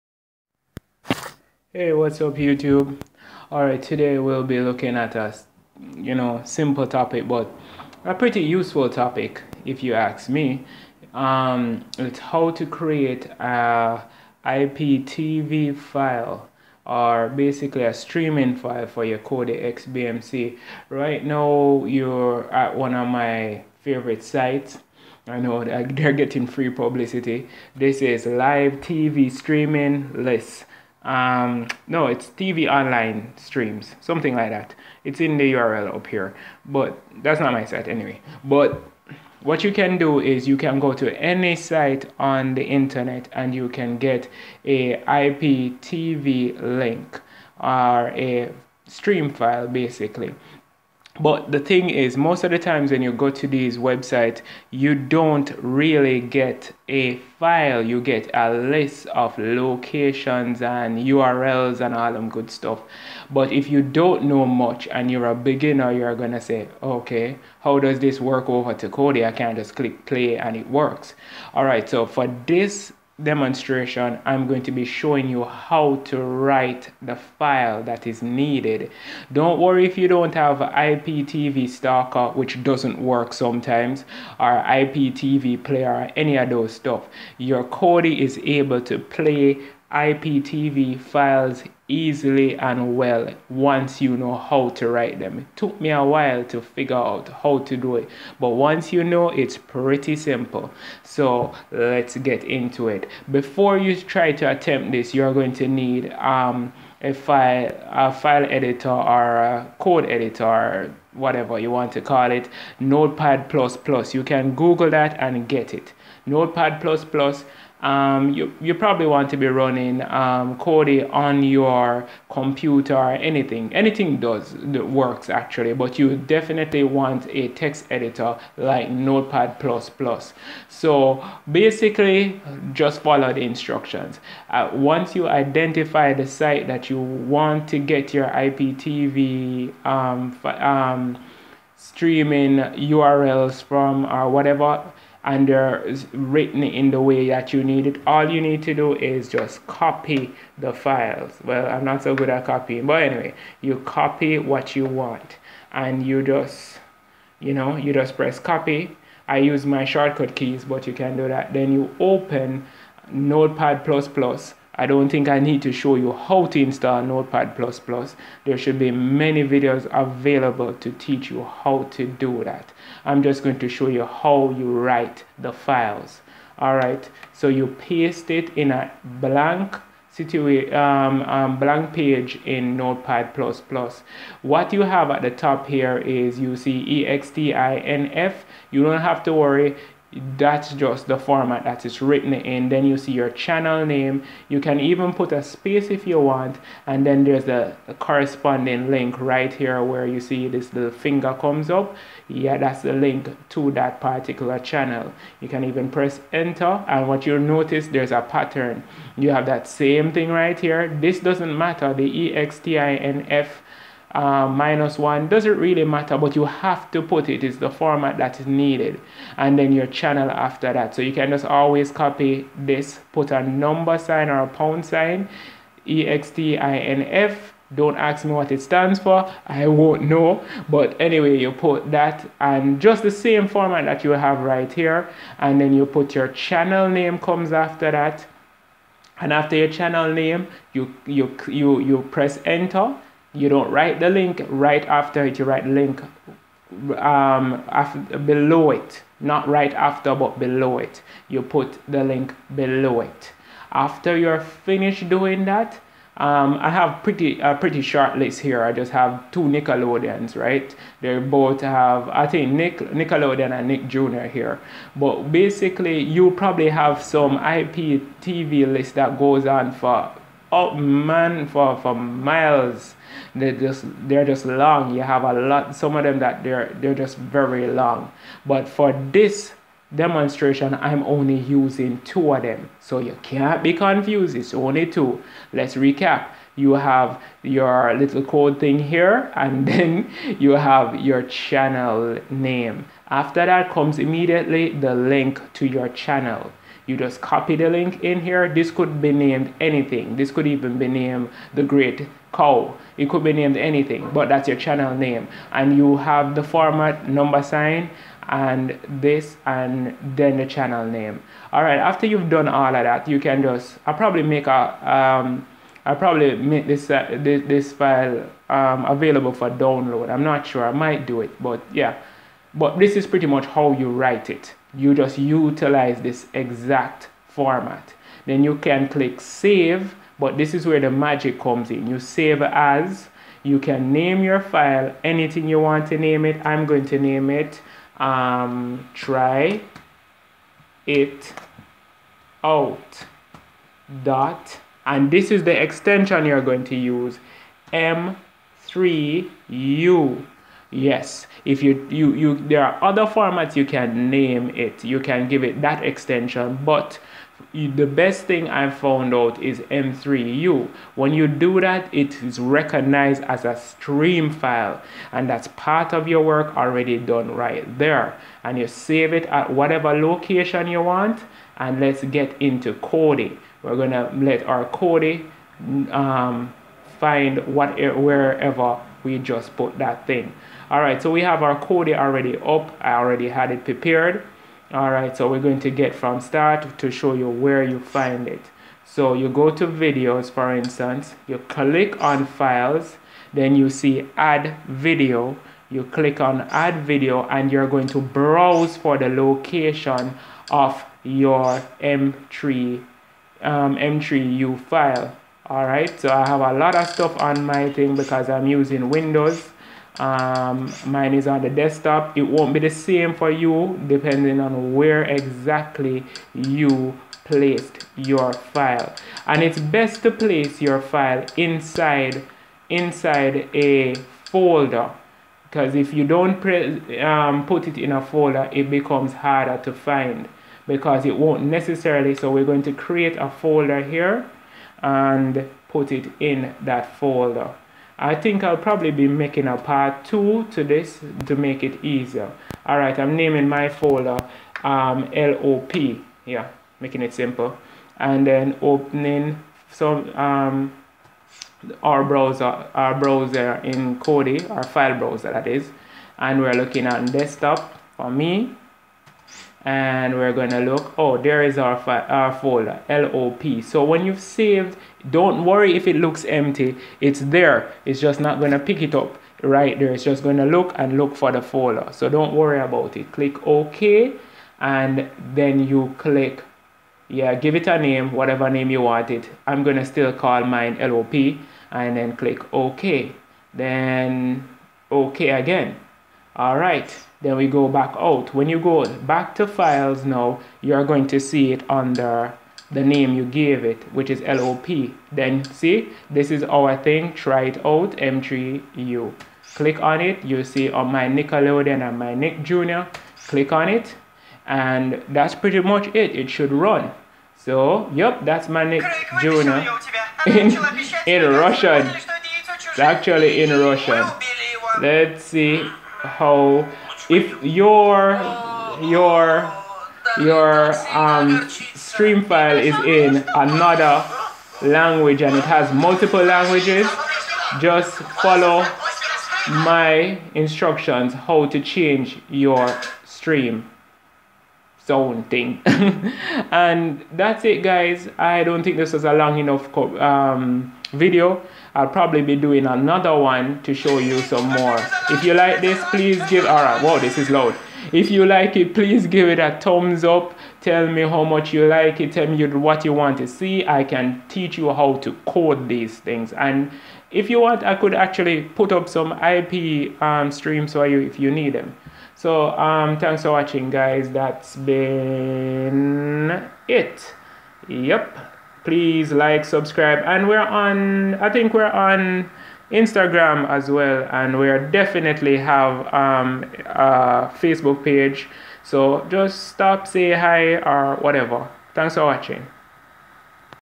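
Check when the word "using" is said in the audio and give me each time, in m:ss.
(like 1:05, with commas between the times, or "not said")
4:41, 6:48.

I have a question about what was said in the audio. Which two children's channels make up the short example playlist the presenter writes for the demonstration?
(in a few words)
Nickelodeon and Nick Jr.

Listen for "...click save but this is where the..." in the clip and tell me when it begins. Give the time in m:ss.
5:28.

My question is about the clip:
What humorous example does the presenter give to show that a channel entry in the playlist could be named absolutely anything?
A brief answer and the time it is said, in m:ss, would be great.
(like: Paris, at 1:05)
the great cow, at 5:01.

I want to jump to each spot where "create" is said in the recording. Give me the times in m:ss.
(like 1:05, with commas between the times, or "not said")
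0:12, 7:12.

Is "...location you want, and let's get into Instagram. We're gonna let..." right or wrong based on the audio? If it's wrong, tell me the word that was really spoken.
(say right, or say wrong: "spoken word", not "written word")
wrong: "Kodi", not "Instagram".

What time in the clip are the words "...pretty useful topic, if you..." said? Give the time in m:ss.
0:08.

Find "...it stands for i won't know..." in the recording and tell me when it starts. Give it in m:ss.
3:48.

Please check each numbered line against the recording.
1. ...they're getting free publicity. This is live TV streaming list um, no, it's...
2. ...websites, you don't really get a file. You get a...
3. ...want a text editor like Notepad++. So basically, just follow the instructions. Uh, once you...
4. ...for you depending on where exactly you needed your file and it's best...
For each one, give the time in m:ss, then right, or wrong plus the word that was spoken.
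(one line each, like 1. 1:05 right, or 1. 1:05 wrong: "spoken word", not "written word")
1. 0:25 right
2. 0:53 right
3. 2:06 right
4. 6:53 wrong: "placed", not "needed".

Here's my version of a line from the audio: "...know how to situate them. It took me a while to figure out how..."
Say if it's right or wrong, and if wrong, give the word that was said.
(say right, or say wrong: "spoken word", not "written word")
wrong: "write", not "situate".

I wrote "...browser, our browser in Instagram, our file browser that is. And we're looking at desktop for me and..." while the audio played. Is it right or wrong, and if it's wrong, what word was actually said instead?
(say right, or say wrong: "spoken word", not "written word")
wrong: "Kodi", not "Instagram".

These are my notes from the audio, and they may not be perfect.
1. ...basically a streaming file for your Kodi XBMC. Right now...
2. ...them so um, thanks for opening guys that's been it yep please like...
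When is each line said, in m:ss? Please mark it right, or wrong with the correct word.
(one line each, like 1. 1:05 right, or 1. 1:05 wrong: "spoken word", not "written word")
1. 0:17 right
2. 9:21 wrong: "watching", not "opening".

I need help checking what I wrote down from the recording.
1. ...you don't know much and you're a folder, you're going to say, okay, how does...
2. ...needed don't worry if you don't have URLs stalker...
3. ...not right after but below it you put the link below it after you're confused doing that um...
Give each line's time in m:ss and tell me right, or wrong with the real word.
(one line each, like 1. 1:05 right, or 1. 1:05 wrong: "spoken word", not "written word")
1. 1:03 wrong: "beginner", not "folder"
2. 1:18 wrong: "IPTV", not "URLs"
3. 4:09 wrong: "finished", not "confused".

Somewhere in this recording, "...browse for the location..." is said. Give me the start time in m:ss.
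6:37.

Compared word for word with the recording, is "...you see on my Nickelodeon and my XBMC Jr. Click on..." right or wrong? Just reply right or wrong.
wrong.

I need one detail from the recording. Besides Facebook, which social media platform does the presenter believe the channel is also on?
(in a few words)
Instagram.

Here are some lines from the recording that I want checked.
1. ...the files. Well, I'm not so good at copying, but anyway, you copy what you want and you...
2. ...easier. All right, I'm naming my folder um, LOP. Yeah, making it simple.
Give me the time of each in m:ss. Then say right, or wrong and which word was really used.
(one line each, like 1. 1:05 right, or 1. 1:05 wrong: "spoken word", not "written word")
1. 2:30 right
2. 7:21 right.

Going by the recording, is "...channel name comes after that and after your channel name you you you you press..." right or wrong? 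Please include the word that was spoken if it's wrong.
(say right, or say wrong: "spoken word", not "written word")
right.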